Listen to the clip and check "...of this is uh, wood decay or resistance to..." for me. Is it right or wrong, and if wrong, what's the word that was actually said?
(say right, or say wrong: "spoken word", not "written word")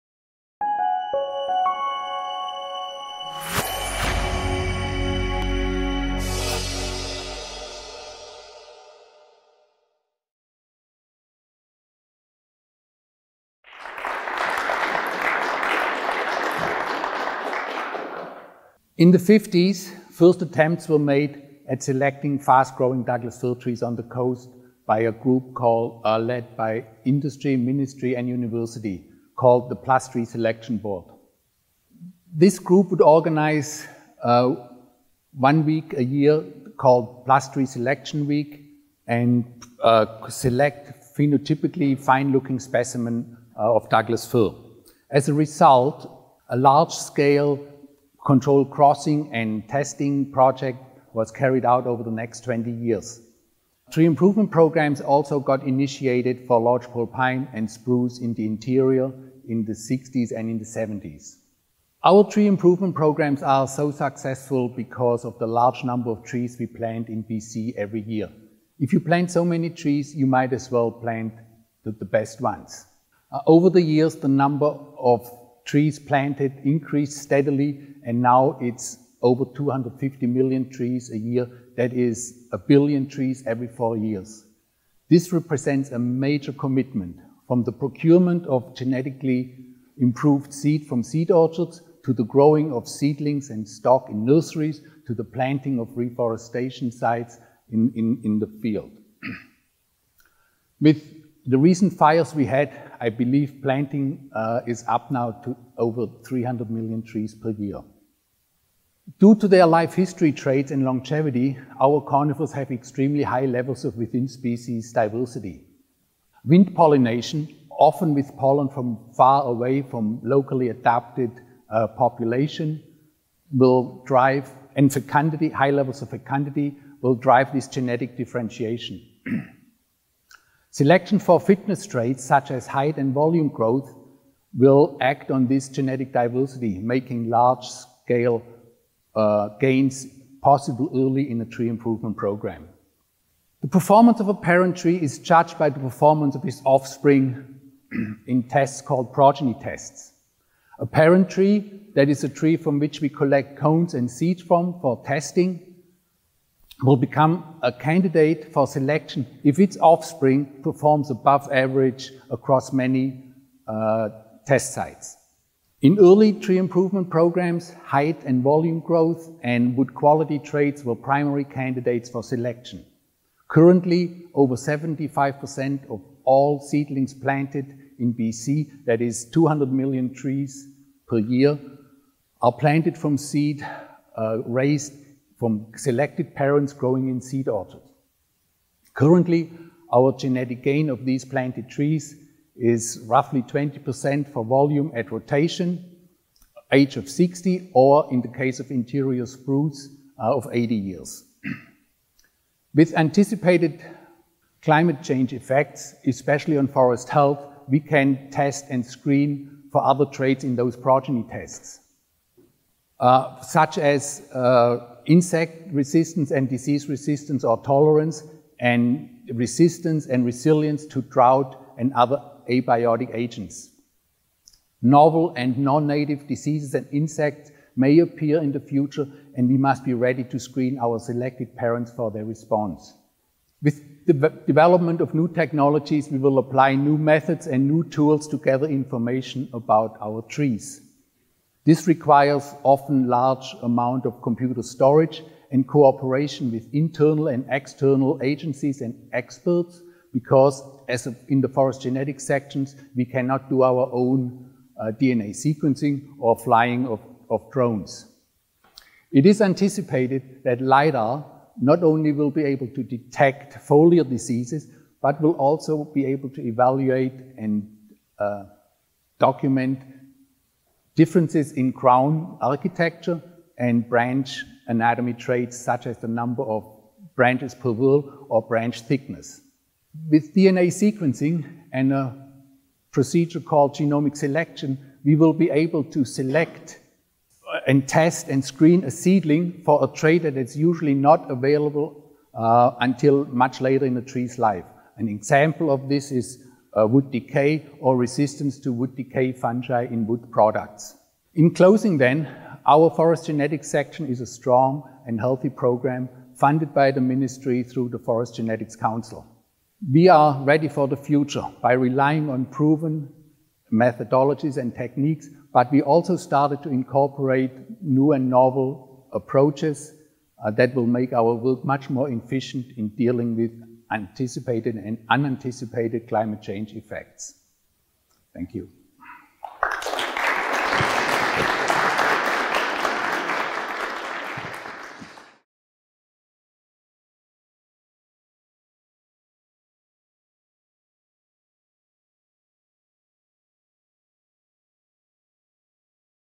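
right.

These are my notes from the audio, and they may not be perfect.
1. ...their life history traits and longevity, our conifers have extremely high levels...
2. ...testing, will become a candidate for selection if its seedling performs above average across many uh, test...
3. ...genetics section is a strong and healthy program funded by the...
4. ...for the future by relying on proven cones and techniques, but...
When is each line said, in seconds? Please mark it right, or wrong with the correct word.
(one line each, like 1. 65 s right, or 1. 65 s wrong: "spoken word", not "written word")
1. 109 s right
2. 155 s wrong: "offspring", not "seedling"
3. 303 s right
4. 310 s wrong: "methodologies", not "cones".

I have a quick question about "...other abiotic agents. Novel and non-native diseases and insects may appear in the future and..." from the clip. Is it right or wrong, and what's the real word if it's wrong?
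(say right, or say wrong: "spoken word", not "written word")
right.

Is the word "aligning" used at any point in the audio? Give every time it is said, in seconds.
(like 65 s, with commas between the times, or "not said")
not said.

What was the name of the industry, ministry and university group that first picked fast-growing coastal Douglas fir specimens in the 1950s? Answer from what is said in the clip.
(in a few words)
Plus Tree Selection Board.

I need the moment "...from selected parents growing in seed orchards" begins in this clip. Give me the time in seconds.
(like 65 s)
185 s.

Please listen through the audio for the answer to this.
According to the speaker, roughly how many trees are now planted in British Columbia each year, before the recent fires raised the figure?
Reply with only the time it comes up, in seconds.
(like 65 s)
79 s.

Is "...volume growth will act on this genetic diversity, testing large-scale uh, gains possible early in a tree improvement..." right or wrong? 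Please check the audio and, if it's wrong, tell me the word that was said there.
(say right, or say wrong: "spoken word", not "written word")
wrong: "making", not "testing".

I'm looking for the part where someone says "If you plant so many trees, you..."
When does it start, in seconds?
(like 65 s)
68 s.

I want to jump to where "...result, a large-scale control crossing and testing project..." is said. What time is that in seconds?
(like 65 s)
45 s.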